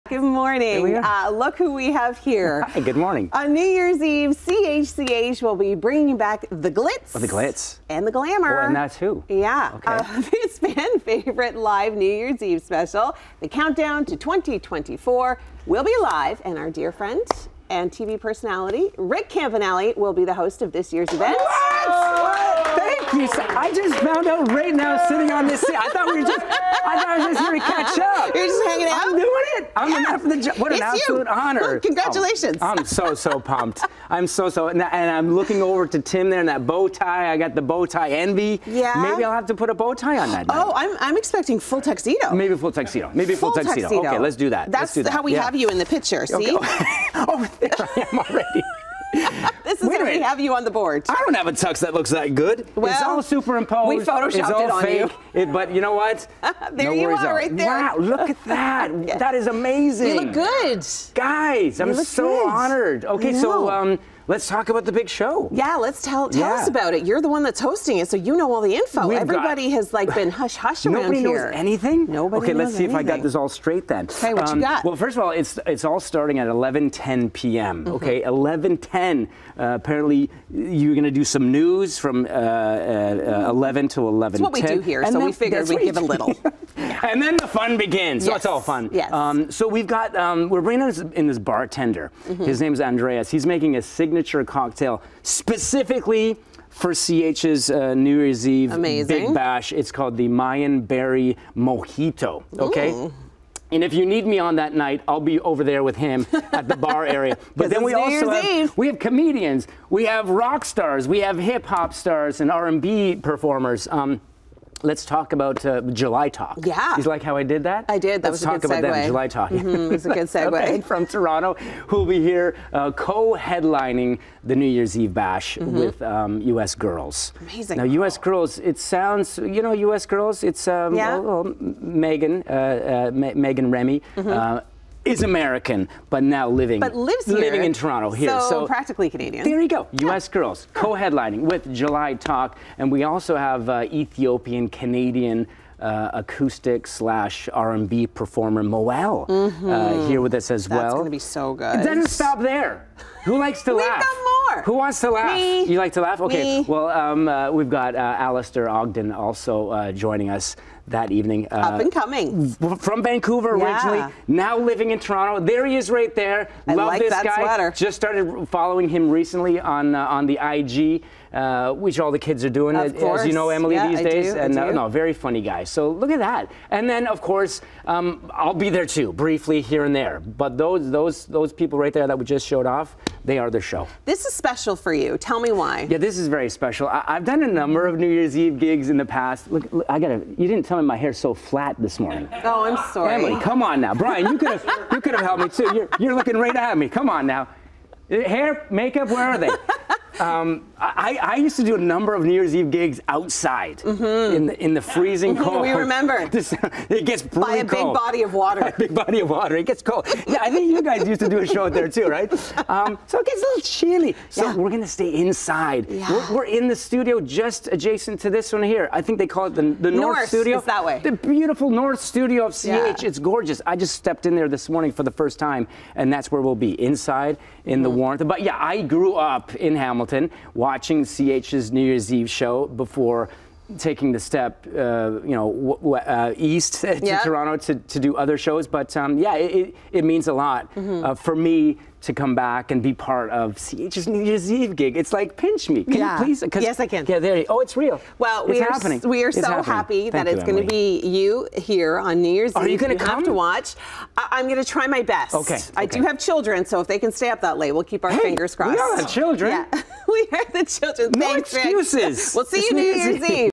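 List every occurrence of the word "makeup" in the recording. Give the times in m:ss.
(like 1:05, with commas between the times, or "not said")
3:18.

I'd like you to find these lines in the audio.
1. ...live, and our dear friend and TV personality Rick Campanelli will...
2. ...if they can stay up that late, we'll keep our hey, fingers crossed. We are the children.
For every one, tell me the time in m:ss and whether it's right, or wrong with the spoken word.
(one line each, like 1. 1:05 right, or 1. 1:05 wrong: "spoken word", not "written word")
1. 0:16 right
2. 4:16 right.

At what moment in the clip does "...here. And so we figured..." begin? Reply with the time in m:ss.
1:24.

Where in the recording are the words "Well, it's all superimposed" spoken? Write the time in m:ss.
0:52.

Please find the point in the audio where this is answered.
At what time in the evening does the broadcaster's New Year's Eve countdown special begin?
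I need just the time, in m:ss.
1:16.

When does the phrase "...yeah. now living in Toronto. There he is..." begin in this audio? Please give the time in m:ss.
2:43.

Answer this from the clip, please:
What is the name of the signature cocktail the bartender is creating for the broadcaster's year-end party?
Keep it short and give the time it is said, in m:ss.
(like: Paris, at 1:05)
Mayan Berry Mojito, at 1:40.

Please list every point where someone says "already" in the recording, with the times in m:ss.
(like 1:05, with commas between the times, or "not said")
0:48.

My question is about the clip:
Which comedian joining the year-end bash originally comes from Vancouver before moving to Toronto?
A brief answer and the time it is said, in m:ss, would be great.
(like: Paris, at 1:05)
Alistair Ogden, at 2:38.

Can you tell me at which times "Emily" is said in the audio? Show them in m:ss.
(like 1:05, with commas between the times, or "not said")
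2:53, 3:13.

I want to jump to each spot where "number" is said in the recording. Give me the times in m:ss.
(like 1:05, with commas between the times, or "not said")
3:07, 3:21.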